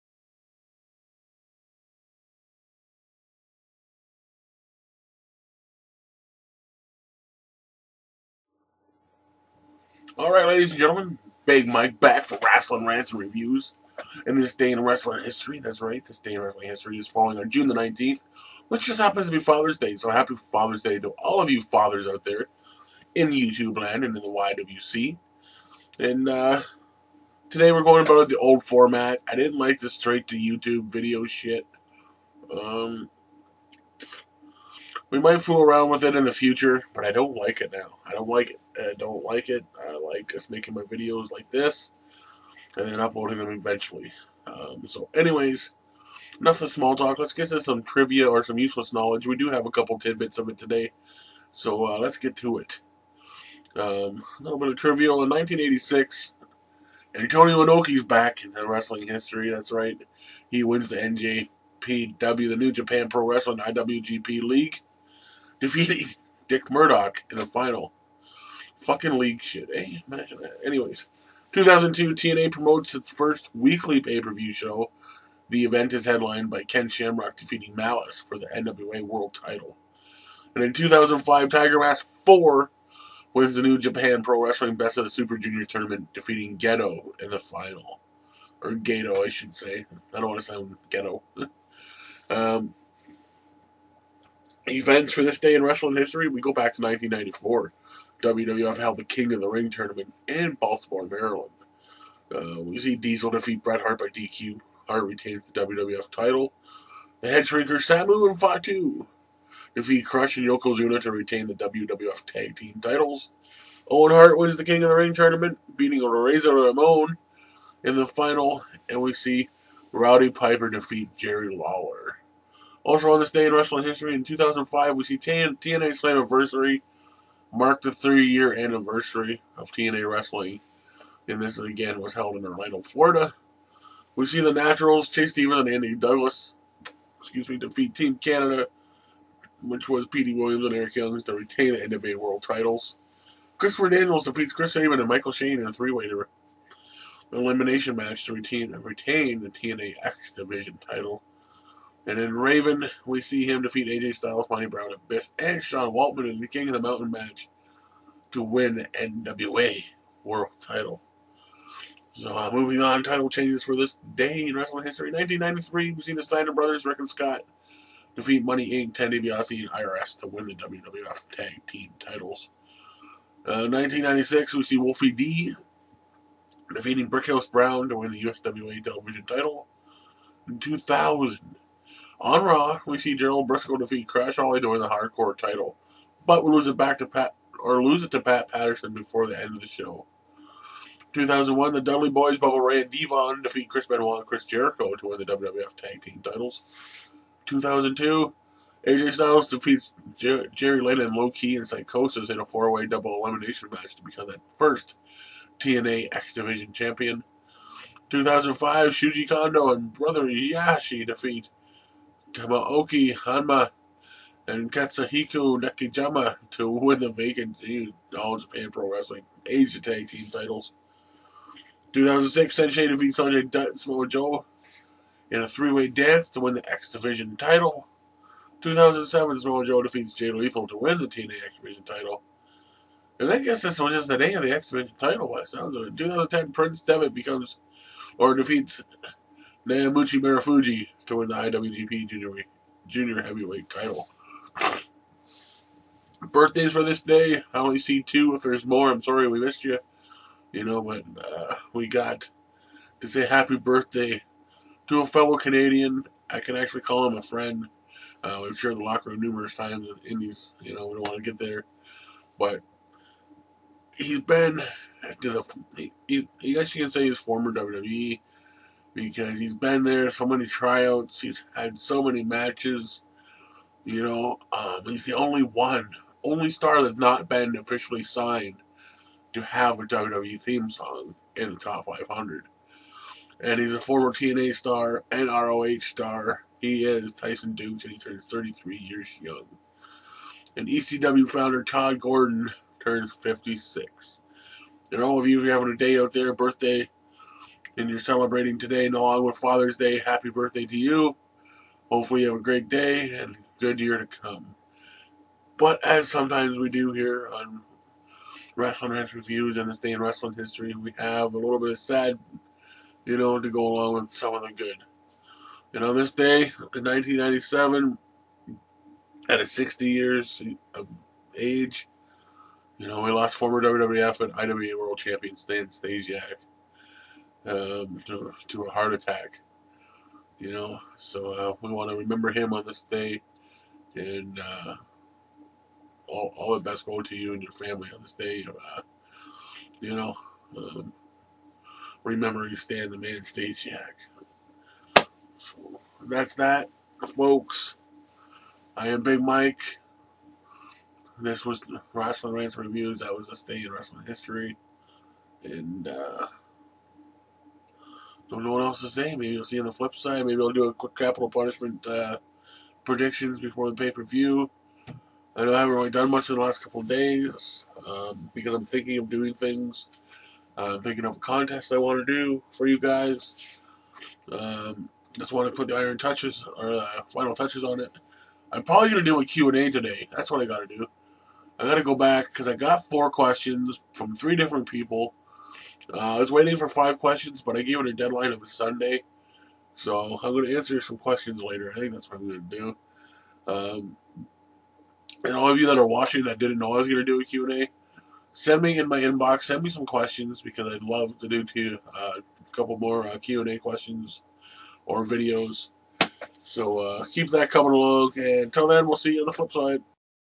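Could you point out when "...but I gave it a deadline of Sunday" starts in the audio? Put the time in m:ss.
6:27.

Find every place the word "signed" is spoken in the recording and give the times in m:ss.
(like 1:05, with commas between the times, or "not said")
4:38.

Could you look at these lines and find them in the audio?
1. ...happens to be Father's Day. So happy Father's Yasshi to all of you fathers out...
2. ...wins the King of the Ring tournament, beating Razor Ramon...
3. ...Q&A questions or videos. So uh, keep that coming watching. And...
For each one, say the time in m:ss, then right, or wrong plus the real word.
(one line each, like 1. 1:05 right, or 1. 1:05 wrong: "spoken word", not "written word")
1. 0:18 wrong: "Day", not "Yasshi"
2. 1:54 right
3. 6:43 wrong: "along", not "watching".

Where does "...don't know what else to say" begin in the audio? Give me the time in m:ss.
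5:58.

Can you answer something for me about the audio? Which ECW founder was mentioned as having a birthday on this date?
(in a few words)
Todd Gordon.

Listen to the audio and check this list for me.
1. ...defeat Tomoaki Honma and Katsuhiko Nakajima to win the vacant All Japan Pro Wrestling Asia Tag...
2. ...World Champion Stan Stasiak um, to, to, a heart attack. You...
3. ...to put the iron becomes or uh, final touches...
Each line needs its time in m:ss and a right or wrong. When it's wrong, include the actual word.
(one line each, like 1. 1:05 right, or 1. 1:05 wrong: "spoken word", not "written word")
1. 3:31 right
2. 5:24 right
3. 6:15 wrong: "touches", not "becomes".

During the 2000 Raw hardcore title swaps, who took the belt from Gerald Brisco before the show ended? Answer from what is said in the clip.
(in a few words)
Pat Patterson.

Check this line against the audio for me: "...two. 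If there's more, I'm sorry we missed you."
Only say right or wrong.
right.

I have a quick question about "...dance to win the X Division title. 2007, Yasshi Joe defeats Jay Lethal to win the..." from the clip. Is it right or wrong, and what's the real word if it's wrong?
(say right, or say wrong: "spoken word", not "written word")
wrong: "Samoa", not "Yasshi".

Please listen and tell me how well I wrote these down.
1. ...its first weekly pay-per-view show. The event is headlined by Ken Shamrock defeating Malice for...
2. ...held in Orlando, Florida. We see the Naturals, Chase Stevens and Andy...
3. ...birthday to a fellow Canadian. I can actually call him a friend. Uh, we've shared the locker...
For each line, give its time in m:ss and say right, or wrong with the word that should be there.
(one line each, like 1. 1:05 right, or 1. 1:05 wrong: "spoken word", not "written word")
1. 1:12 right
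2. 2:12 right
3. 4:13 right.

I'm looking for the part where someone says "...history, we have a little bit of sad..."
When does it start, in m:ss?
5:10.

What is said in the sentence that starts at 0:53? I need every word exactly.
Um, a little bit of trivia.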